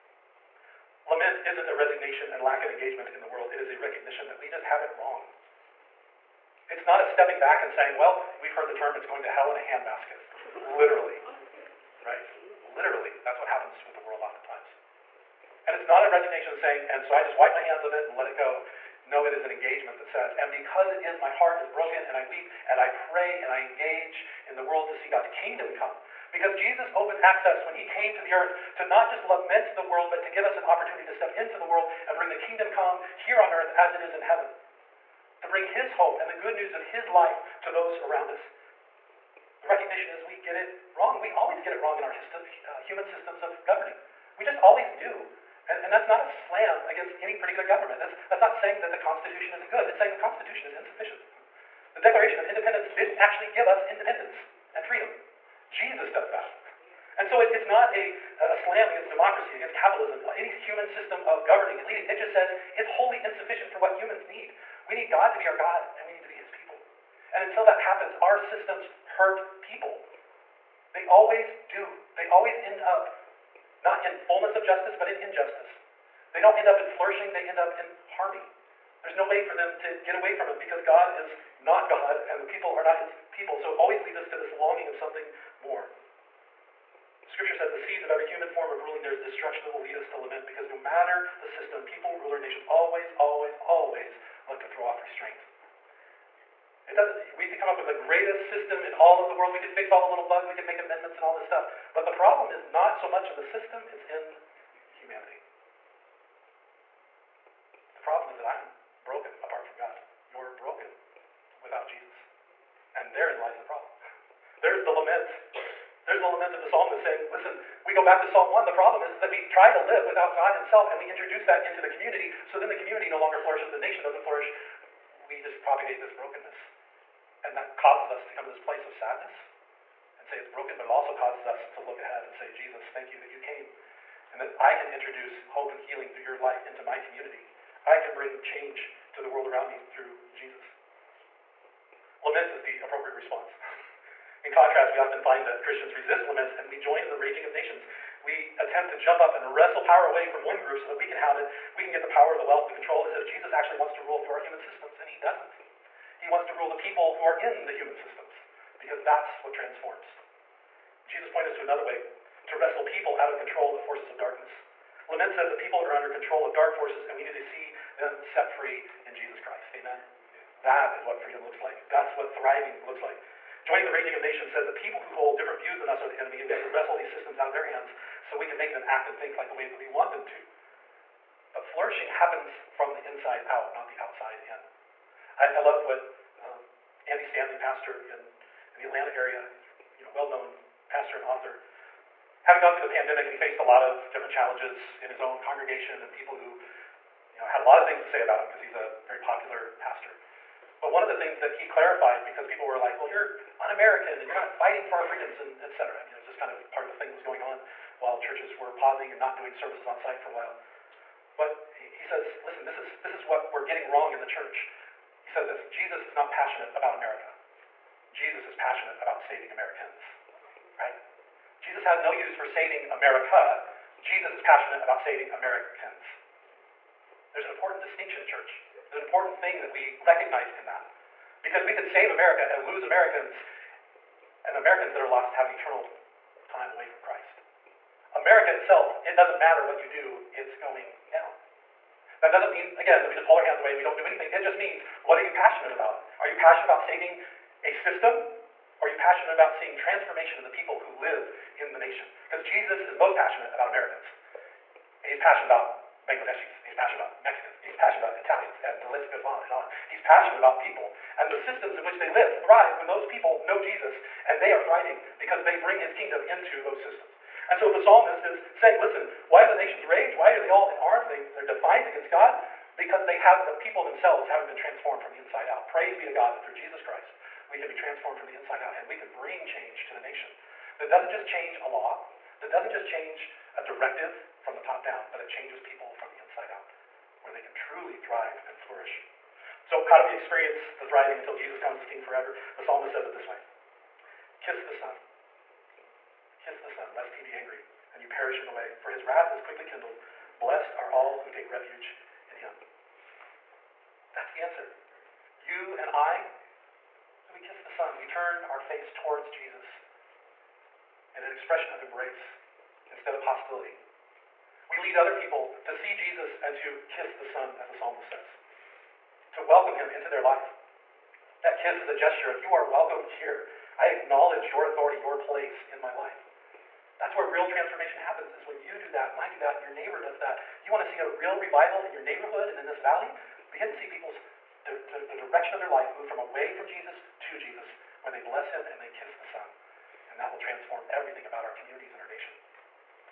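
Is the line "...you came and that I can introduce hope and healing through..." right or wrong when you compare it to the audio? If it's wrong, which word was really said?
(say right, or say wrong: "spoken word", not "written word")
right.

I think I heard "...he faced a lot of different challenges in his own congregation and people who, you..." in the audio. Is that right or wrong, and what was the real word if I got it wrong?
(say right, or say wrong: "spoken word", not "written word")
right.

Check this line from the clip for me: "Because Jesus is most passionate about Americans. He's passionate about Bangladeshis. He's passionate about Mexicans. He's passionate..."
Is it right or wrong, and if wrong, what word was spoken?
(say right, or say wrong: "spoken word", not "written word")
right.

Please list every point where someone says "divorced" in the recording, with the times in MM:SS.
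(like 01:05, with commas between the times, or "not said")
not said.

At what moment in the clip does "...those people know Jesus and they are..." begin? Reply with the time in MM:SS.
04:22.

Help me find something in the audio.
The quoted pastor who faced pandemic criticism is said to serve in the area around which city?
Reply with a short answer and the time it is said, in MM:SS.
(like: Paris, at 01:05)
Atlanta, at 03:08.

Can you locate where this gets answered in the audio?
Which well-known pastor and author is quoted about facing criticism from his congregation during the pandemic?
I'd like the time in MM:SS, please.
03:07.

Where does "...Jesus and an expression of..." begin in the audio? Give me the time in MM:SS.
05:09.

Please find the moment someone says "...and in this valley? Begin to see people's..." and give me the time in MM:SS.
05:32.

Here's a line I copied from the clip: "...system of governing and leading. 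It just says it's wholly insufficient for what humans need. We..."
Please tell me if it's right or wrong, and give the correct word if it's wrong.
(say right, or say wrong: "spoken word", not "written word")
right.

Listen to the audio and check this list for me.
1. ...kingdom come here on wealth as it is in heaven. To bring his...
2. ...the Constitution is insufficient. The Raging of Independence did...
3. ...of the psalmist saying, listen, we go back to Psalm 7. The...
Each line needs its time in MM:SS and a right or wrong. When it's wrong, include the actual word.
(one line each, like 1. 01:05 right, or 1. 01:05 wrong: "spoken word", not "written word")
1. 00:32 wrong: "earth", not "wealth"
2. 00:50 wrong: "Declaration", not "Raging"
3. 01:56 wrong: "1", not "7".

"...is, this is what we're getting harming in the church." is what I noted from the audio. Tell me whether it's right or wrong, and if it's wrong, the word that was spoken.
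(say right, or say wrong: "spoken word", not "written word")
wrong: "wrong", not "harming".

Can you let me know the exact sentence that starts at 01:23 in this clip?
So it always leads us to this longing of something more.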